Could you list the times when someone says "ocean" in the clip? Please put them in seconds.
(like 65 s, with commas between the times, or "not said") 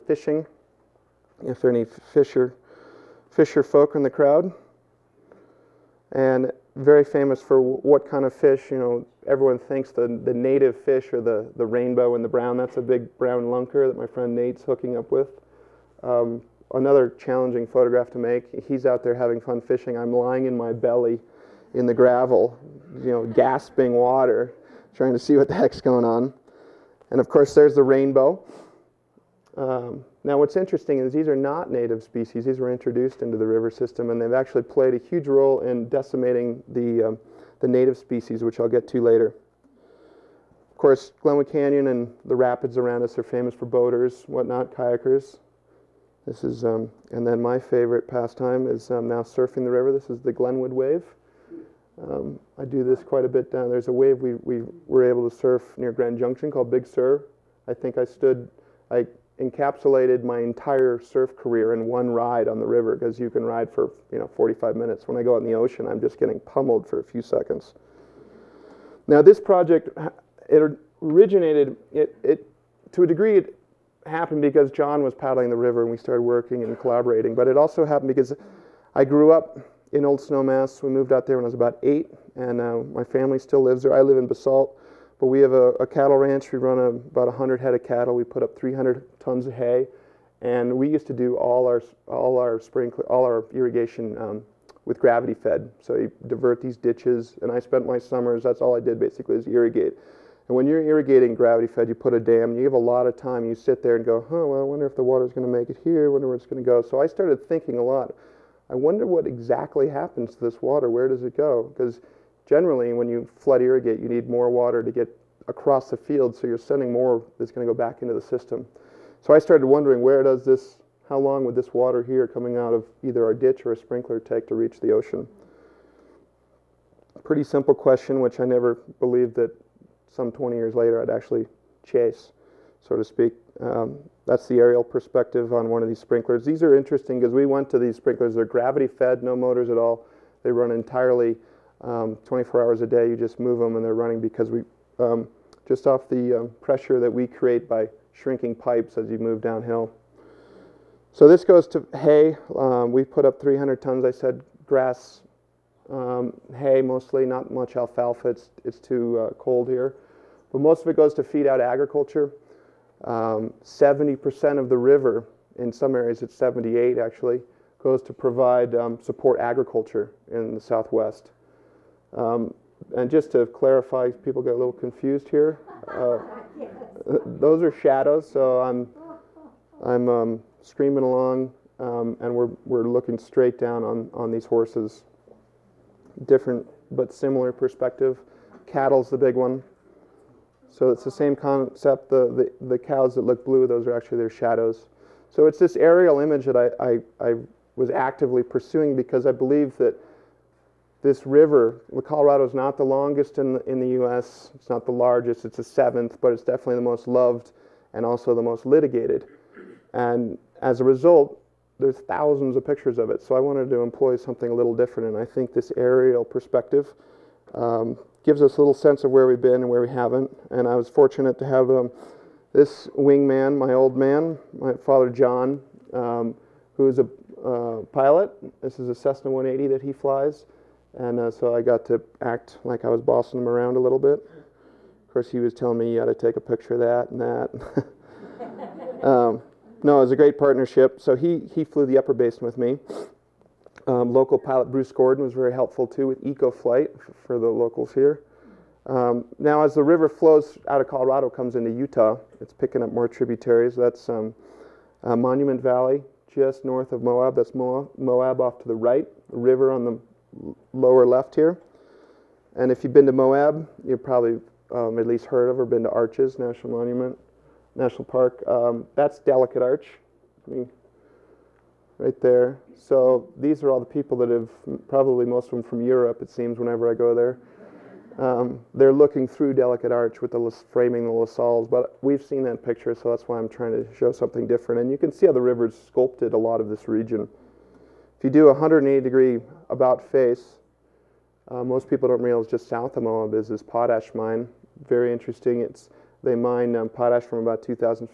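65 s, 124 s.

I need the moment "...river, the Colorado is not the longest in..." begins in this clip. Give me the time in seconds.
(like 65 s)
201 s.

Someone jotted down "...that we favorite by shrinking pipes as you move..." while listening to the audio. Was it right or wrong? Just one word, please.
wrong.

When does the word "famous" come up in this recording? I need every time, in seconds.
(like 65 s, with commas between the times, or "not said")
7 s, 43 s.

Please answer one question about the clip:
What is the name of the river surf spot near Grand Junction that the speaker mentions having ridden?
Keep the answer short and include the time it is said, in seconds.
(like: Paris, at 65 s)
Big Sur, at 56 s.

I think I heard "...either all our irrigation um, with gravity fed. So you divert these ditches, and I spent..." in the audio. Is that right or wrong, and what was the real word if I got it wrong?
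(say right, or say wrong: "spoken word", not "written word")
wrong: "sprinkler", not "either".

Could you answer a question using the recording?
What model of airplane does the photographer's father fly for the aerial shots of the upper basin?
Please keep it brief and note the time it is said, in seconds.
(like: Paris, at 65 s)
Cessna 180, at 228 s.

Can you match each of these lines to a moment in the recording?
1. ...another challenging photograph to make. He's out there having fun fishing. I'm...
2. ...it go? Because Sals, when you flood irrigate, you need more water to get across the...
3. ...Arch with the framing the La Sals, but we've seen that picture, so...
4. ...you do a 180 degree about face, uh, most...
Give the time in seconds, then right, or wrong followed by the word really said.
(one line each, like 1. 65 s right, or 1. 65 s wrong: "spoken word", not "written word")
1. 16 s right
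2. 111 s wrong: "Generally", not "Sals"
3. 279 s right
4. 288 s right.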